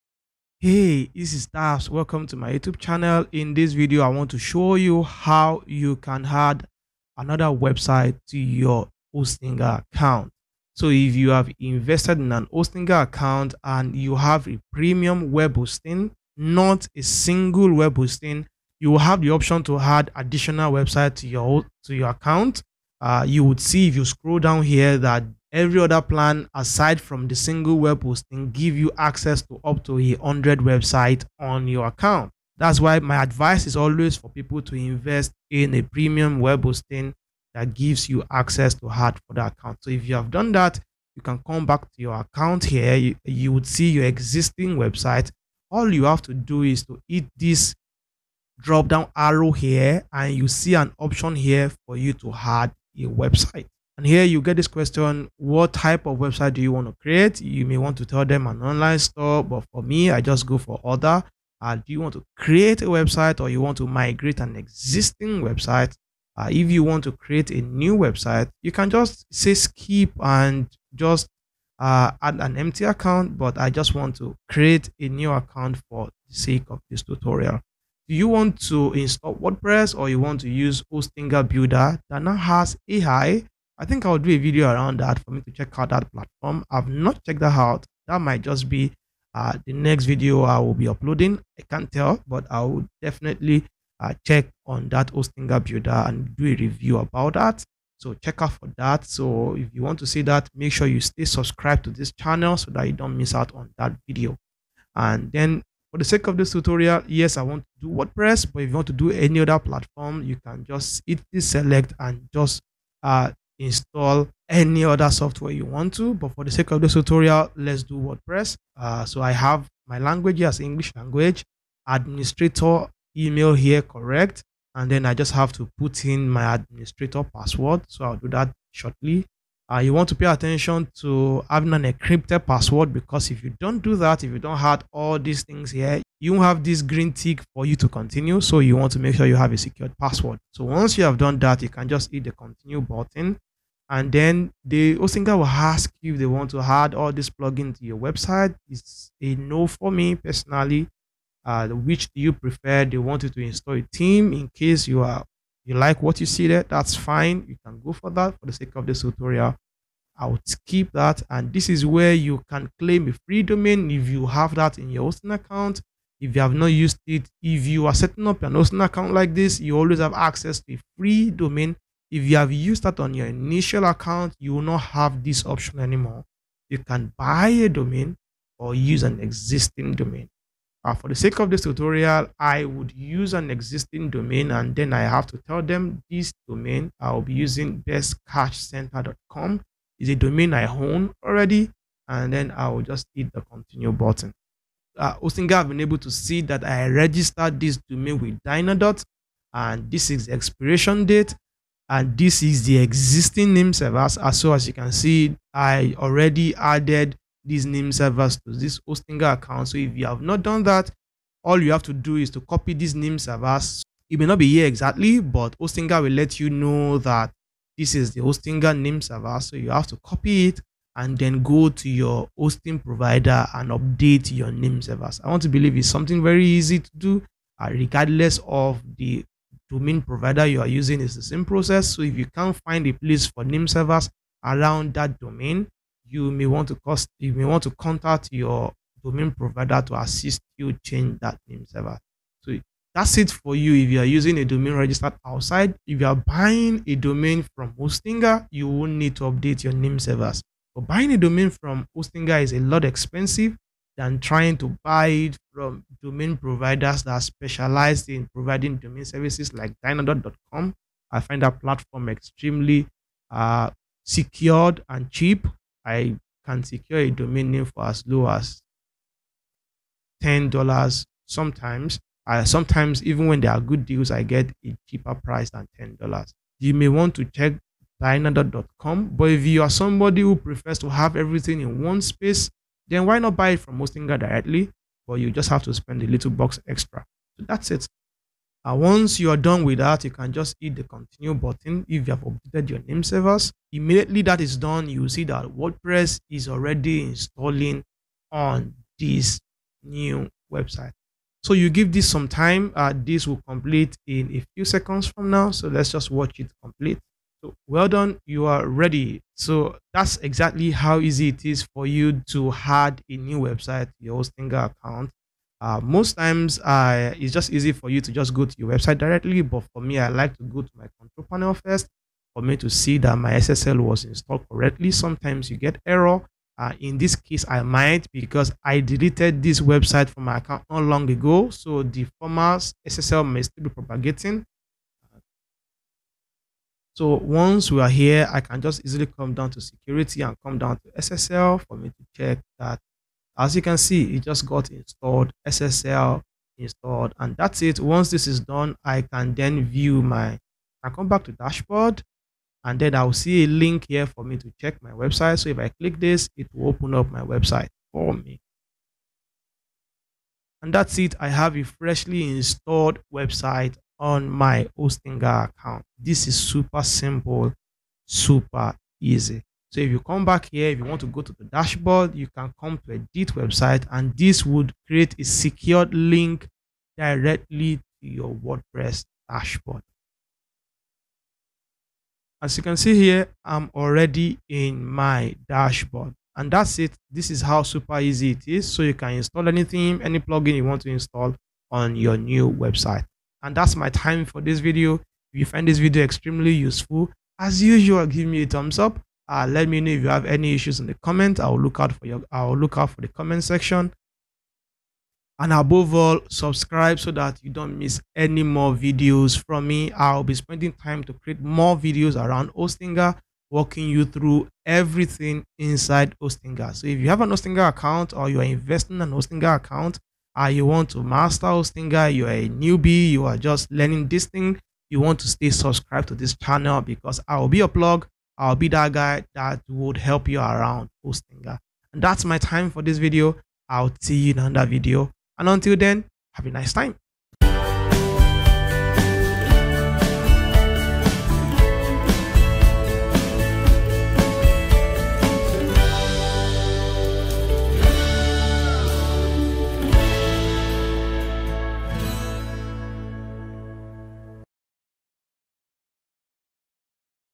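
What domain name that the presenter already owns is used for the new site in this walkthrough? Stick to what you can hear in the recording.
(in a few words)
bestcashcenter.com.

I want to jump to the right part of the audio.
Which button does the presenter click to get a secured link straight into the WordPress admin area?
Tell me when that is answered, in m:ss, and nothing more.
6:12.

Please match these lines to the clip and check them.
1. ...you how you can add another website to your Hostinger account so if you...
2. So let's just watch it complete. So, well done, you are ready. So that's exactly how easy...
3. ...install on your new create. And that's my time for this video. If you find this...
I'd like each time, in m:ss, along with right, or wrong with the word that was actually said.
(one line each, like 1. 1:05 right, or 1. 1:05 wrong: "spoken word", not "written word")
1. 0:04 right
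2. 5:05 right
3. 6:30 wrong: "website", not "create".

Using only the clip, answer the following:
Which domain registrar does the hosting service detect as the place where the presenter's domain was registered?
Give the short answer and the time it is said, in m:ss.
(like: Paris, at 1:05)
Dynadot, at 3:18.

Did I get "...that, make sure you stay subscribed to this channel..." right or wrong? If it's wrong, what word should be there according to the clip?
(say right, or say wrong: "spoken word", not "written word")
right.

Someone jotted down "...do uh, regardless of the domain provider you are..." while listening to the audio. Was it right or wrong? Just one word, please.
right.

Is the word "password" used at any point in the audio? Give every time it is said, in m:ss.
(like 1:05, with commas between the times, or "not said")
2:07, 2:12, 2:19.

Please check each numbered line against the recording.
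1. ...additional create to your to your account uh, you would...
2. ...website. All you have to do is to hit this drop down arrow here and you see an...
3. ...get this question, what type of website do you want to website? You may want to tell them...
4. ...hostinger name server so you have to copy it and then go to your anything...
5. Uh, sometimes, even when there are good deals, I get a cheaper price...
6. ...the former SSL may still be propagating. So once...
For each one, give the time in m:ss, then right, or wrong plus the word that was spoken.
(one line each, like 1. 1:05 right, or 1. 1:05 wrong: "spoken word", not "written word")
1. 0:20 wrong: "website", not "create"
2. 0:44 right
3. 0:54 wrong: "create", not "website"
4. 3:38 wrong: "hosting", not "anything"
5. 4:32 right
6. 5:31 right.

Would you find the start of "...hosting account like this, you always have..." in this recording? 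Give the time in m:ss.
2:48.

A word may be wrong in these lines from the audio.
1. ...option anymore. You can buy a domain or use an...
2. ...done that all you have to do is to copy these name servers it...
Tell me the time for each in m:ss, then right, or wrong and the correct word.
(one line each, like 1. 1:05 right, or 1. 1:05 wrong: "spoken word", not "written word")
1. 2:55 right
2. 3:30 right.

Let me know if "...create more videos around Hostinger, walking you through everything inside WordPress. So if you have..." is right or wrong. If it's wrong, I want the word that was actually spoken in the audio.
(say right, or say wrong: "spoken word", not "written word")
wrong: "Hostinger", not "WordPress".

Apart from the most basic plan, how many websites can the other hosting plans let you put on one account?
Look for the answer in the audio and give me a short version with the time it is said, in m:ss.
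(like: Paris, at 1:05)
100, at 0:29.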